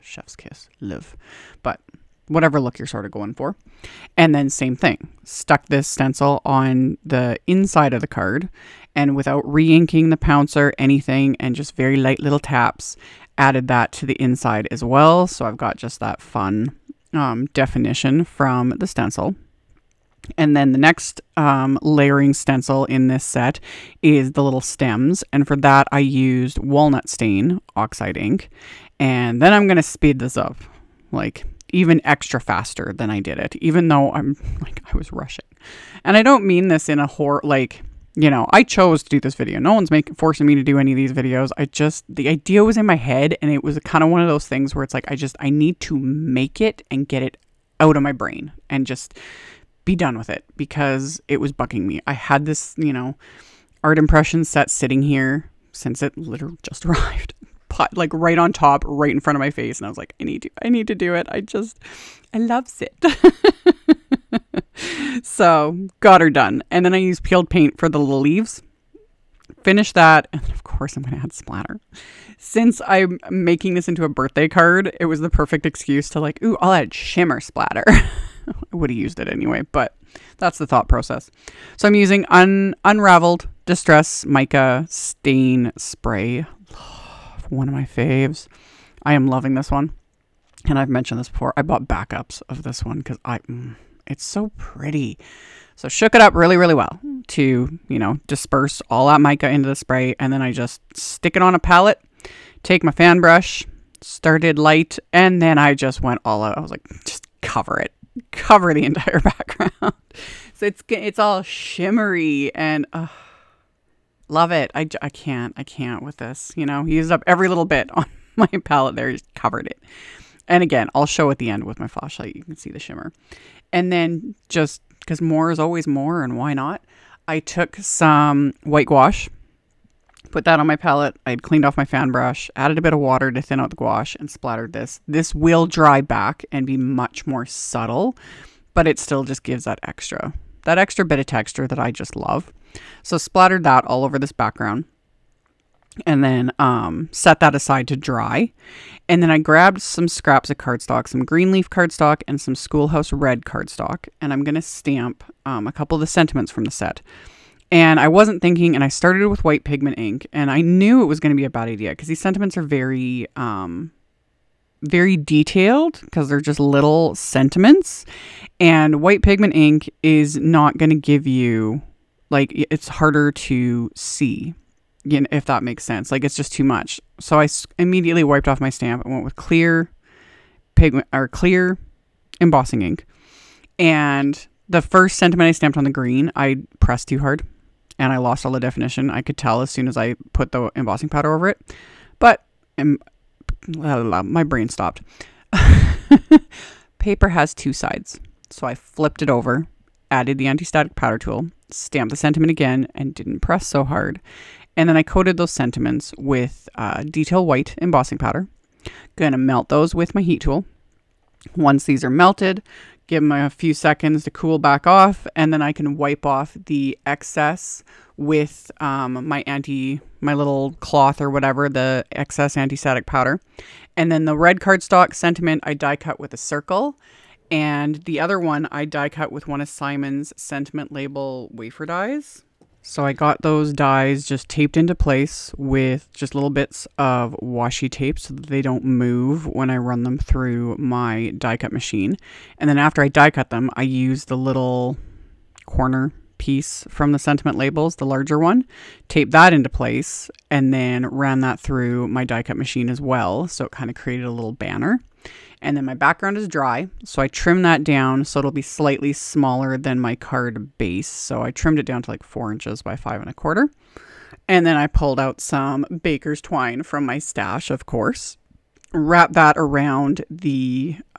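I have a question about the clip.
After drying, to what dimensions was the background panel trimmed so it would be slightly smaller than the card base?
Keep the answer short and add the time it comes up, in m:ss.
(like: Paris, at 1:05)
4 by 5 1/4 inches, at 4:22.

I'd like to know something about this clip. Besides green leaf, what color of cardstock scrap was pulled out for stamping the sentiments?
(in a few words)
schoolhouse red.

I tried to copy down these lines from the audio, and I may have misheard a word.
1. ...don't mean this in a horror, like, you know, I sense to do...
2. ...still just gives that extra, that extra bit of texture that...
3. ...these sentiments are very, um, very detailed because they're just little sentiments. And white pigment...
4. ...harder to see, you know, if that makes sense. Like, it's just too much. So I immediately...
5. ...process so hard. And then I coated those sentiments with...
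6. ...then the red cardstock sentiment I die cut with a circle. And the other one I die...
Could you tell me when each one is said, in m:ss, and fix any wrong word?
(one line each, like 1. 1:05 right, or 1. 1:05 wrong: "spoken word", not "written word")
1. 0:36 wrong: "chose", not "sense"
2. 2:18 right
3. 2:42 right
4. 2:52 right
5. 3:23 wrong: "press", not "process"
6. 3:44 right.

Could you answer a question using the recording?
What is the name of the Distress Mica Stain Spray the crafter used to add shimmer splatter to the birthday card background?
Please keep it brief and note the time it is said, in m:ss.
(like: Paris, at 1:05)
Unraveled, at 1:22.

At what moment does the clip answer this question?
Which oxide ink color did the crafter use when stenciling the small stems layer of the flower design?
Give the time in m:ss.
0:26.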